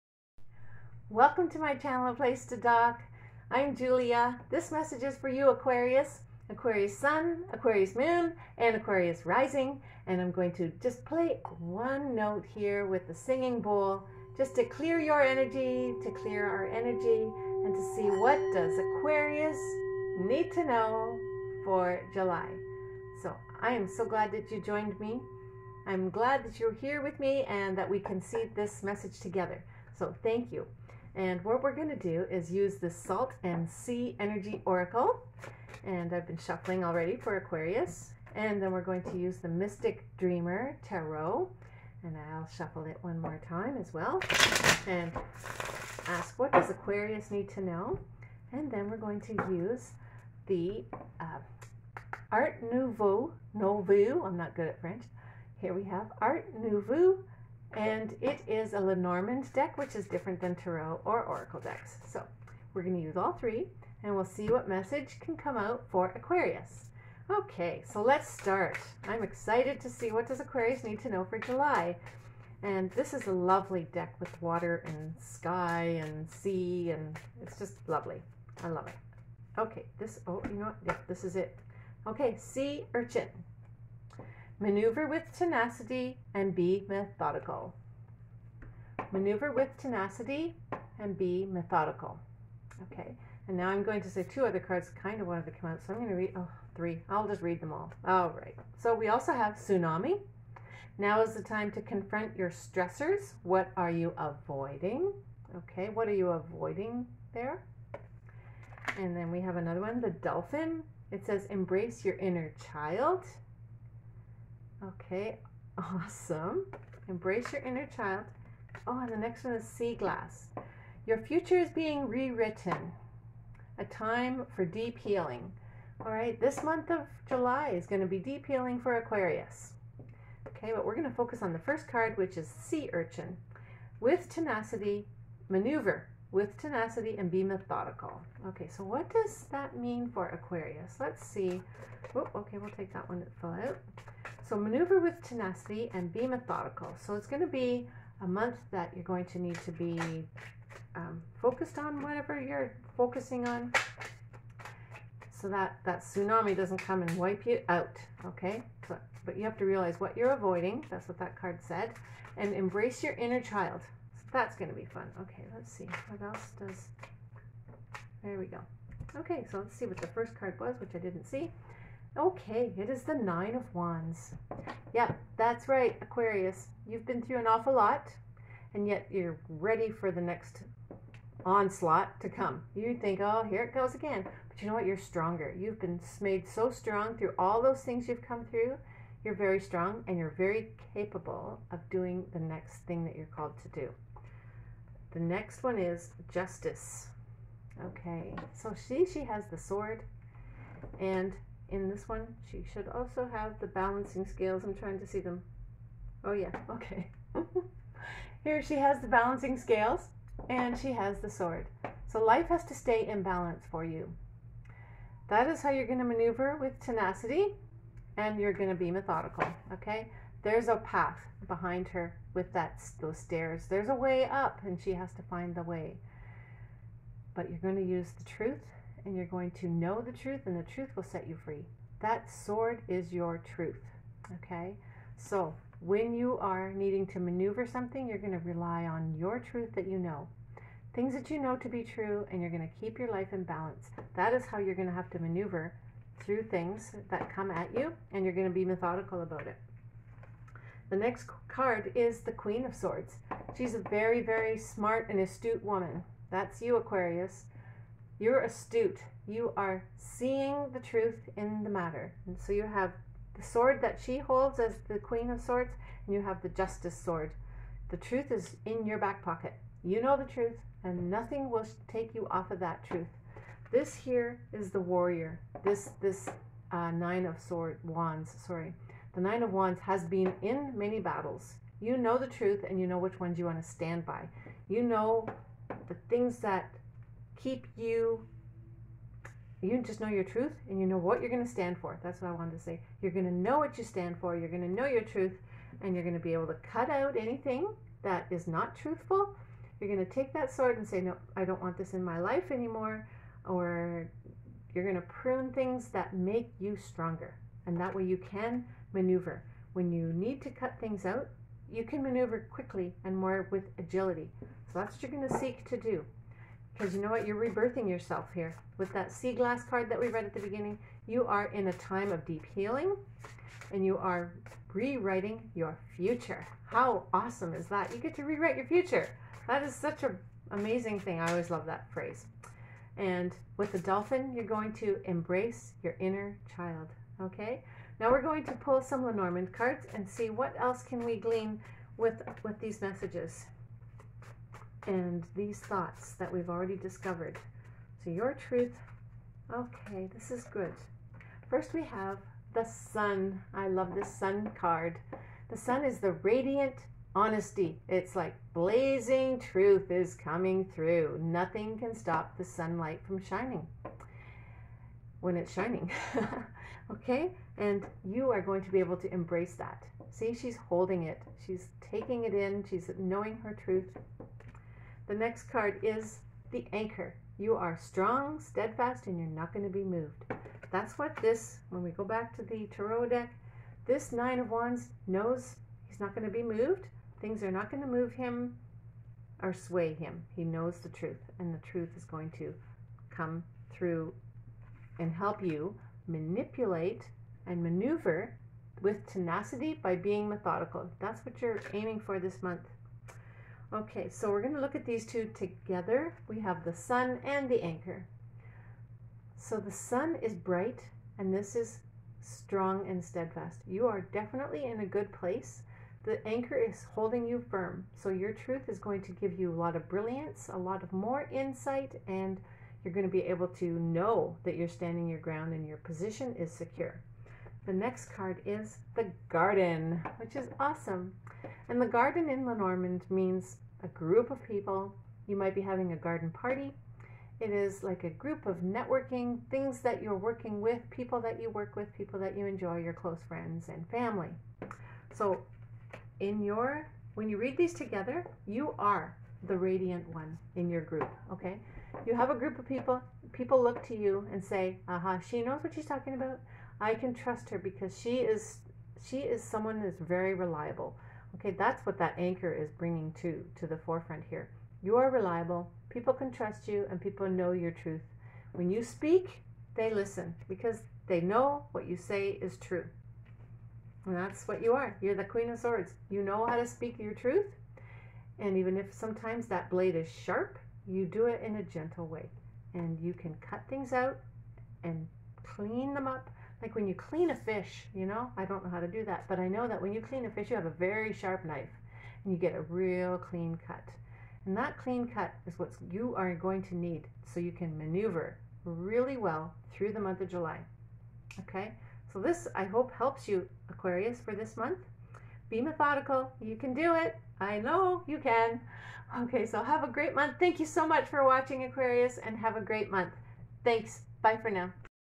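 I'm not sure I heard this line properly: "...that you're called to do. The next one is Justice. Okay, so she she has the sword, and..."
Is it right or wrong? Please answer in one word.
right.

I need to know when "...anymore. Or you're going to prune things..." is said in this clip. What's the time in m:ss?
5:02.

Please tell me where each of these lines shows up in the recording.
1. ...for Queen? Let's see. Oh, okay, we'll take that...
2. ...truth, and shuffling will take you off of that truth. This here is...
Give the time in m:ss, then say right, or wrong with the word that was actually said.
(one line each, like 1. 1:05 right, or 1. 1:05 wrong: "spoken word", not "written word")
1. 2:20 wrong: "Aquarius", not "Queen"
2. 4:30 wrong: "nothing", not "shuffling".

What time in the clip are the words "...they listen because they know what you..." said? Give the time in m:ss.
7:49.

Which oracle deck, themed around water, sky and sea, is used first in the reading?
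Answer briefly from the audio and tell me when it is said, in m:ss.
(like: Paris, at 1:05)
Salt and Sea Energy Oracle, at 0:32.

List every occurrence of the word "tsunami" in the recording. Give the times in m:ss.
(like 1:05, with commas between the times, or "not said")
1:39, 2:36.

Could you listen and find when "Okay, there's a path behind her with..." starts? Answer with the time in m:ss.
3:39.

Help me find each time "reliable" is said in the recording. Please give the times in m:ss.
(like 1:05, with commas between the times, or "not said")
7:40, 7:45.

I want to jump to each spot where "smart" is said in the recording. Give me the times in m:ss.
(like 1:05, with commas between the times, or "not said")
4:14.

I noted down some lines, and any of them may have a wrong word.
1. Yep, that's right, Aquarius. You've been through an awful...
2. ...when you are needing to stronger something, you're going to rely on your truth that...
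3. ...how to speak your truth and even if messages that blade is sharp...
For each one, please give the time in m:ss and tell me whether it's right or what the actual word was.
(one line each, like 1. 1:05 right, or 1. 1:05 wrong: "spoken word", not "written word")
1. 2:54 right
2. 3:55 wrong: "maneuver", not "stronger"
3. 7:56 wrong: "sometimes", not "messages".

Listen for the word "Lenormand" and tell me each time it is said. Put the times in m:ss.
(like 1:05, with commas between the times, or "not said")
0:58, 5:39, 7:12.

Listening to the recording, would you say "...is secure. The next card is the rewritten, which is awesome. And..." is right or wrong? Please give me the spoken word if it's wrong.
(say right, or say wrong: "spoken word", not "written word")
wrong: "garden", not "rewritten".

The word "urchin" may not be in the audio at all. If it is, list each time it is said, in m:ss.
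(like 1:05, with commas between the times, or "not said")
1:22, 2:12.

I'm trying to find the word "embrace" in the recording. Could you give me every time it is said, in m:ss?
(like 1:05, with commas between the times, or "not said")
1:51, 1:57, 2:42, 5:35, 6:09.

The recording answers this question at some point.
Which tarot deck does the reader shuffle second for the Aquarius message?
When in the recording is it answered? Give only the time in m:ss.
0:39.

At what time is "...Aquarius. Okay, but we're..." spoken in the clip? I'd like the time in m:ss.
2:08.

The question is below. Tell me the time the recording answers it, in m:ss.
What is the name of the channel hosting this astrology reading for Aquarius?
0:02.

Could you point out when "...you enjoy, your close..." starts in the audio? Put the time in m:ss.
7:22.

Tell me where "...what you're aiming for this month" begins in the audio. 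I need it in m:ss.
6:41.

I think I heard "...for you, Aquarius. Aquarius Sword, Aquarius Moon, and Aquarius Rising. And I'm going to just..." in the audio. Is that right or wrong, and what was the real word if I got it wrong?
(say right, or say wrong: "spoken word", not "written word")
wrong: "Sun", not "Sword".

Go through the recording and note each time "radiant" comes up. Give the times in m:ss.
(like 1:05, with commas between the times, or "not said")
5:56, 7:29.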